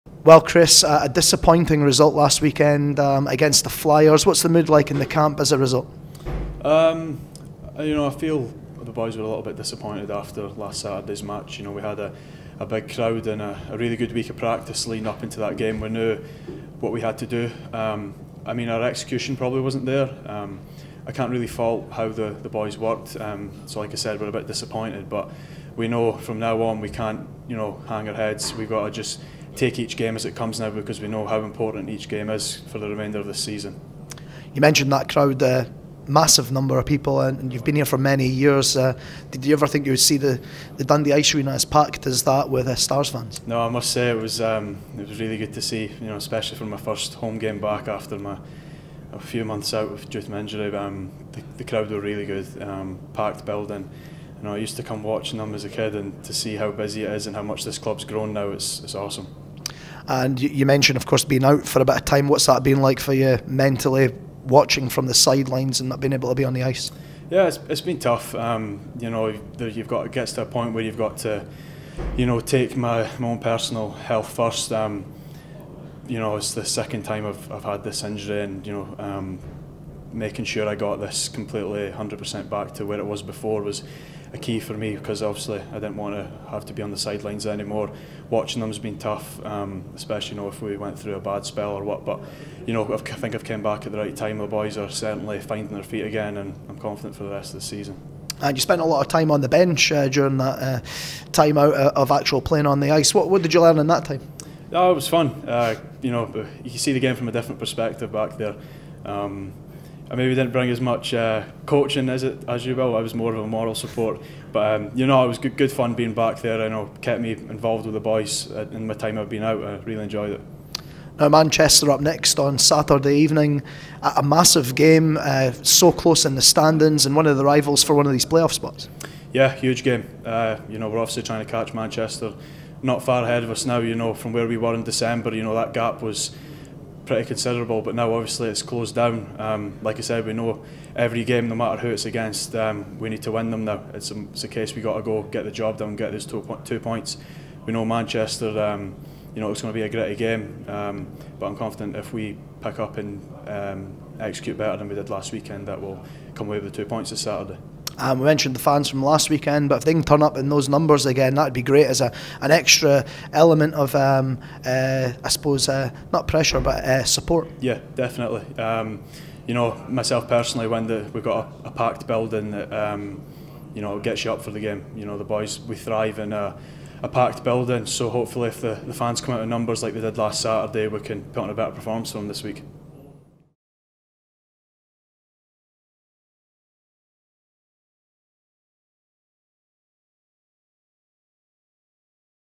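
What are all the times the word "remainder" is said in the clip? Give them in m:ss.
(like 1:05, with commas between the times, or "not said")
0:32.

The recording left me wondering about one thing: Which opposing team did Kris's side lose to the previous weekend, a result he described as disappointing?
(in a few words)
Flyers.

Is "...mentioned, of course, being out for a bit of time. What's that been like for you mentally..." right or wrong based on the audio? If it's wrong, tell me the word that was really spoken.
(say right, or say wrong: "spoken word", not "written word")
right.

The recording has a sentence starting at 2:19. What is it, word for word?
Um, like I said, we know every game, no matter who it's against, um, we need to win them now.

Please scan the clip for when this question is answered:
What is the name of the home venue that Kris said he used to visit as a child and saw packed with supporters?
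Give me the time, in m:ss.
0:40.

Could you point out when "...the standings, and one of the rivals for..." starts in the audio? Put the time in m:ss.
2:06.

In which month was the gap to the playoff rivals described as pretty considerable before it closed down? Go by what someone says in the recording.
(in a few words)
December.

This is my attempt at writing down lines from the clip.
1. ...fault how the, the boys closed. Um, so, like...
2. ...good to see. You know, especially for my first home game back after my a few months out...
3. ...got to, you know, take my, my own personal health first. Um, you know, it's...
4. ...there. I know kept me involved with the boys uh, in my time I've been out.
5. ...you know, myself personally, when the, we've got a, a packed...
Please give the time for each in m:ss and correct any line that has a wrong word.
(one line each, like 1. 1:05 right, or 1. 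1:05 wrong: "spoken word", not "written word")
1. 0:21 wrong: "worked", not "closed"
2. 0:45 right
3. 1:10 right
4. 1:56 right
5. 2:49 right.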